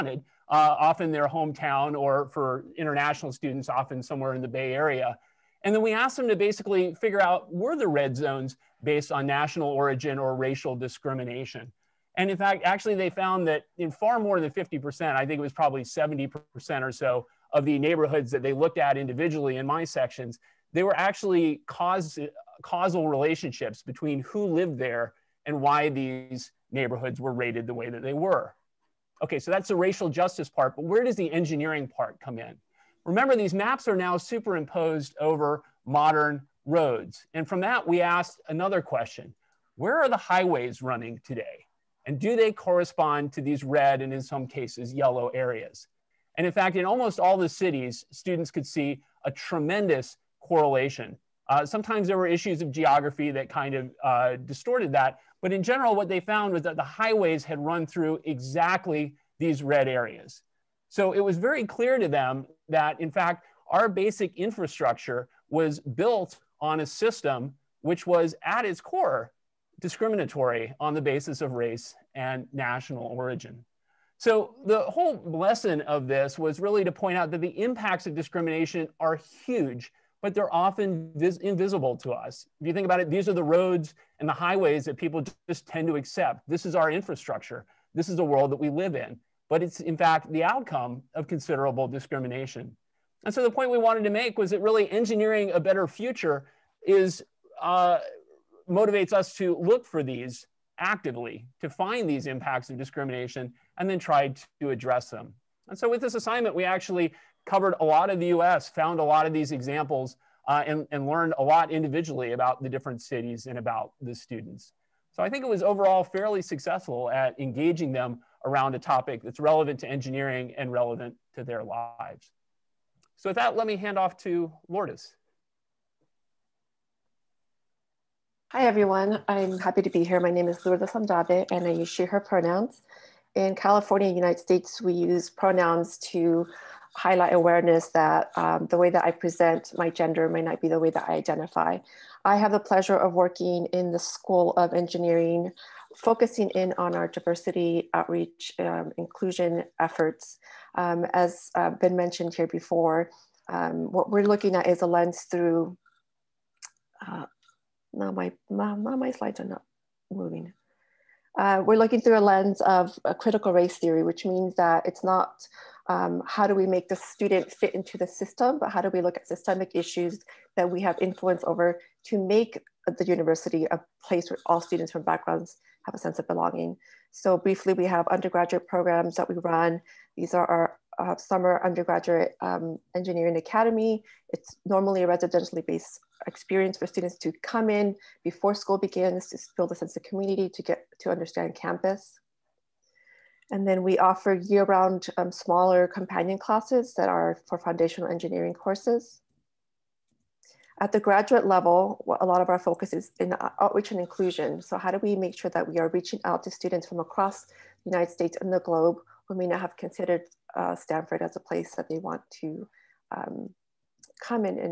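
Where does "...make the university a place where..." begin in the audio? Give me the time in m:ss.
2:52.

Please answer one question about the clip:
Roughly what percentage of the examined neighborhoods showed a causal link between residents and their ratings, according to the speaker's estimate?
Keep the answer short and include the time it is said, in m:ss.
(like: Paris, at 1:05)
70%, at 0:15.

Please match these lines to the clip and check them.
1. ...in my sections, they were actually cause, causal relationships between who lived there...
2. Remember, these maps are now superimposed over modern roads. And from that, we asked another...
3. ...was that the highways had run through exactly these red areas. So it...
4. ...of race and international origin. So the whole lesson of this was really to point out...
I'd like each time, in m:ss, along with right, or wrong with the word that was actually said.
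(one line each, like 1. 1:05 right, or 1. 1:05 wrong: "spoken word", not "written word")
1. 0:19 right
2. 0:33 right
3. 0:56 right
4. 1:11 wrong: "national", not "international".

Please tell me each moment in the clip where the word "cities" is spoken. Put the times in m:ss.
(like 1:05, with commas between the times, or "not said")
0:47, 1:53.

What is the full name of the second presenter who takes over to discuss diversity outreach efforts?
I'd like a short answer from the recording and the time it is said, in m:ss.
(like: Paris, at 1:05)
Lourdes Andrade, at 2:10.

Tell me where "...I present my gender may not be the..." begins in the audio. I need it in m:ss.
2:19.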